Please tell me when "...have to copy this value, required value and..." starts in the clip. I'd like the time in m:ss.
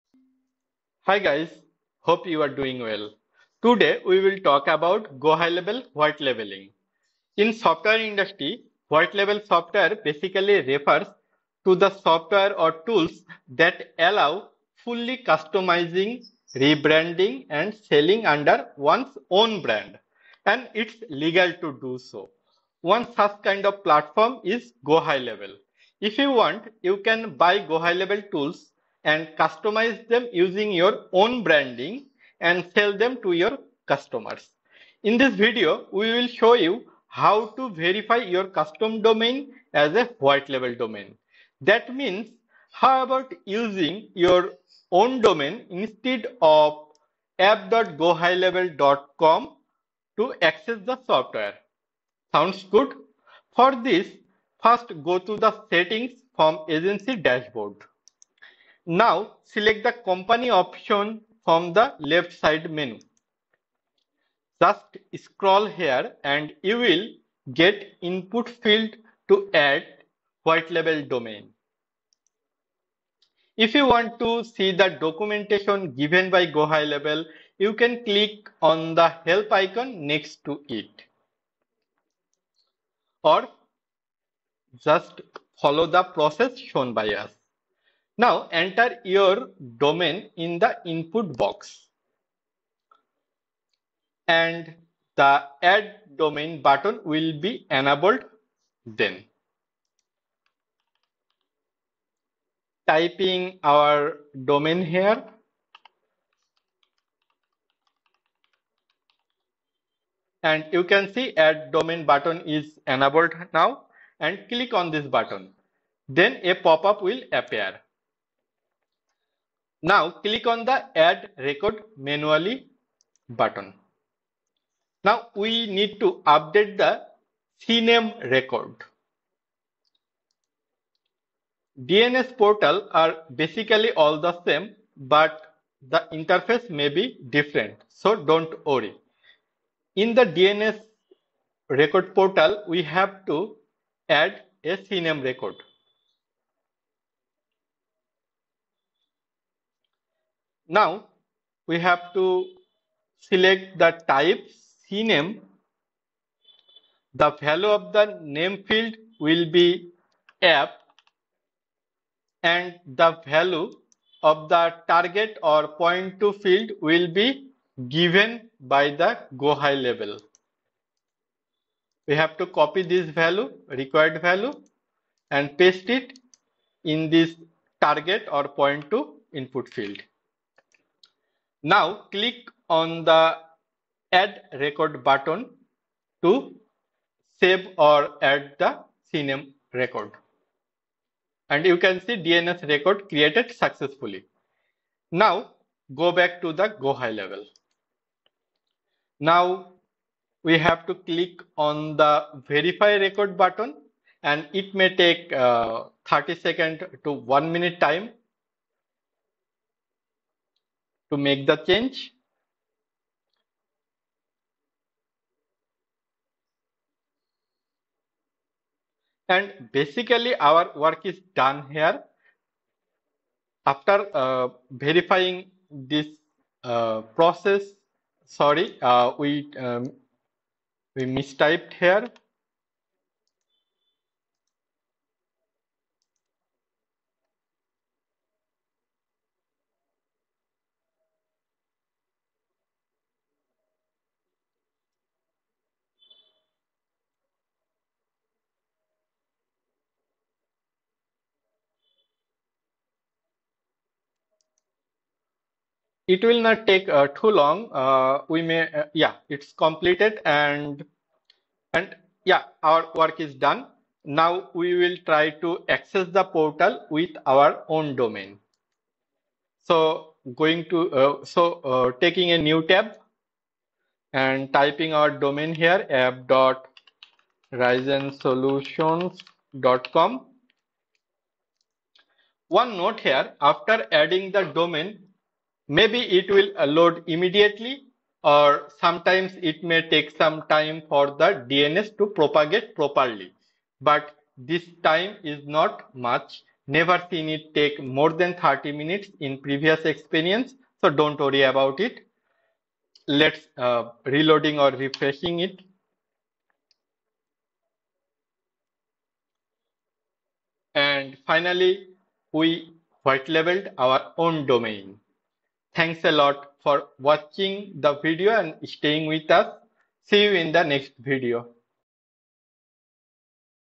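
2:52.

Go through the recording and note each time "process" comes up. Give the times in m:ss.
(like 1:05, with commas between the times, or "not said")
1:26, 3:47.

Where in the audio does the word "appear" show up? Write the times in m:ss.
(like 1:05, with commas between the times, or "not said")
1:57.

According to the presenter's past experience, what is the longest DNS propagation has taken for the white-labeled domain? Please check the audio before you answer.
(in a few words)
30 minutes.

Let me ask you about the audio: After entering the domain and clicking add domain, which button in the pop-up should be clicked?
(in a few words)
Add record manually.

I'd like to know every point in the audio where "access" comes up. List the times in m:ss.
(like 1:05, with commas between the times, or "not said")
0:50, 4:25.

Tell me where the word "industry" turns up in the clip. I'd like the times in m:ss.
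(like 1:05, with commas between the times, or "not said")
0:07.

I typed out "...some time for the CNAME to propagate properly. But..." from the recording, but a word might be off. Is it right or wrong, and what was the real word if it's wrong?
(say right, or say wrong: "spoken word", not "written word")
wrong: "DNS", not "CNAME".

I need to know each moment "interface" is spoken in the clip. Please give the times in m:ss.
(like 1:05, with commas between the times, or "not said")
2:16.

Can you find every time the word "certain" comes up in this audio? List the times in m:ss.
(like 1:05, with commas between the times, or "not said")
not said.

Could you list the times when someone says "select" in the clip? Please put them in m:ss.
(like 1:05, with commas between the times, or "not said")
0:59, 2:33.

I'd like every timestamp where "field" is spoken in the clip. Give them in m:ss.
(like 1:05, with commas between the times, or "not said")
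1:08, 2:38, 2:46, 2:59.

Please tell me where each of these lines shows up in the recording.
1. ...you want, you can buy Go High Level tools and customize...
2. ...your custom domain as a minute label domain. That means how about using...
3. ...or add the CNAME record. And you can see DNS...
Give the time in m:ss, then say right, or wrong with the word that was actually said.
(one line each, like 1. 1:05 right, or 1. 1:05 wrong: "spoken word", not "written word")
1. 0:26 right
2. 0:38 wrong: "white", not "minute"
3. 3:07 right.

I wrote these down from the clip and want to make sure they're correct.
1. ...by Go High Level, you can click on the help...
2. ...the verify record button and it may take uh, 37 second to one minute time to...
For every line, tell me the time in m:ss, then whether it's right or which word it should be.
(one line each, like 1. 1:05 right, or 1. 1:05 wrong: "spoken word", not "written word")
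1. 1:16 right
2. 3:21 wrong: "30", not "37".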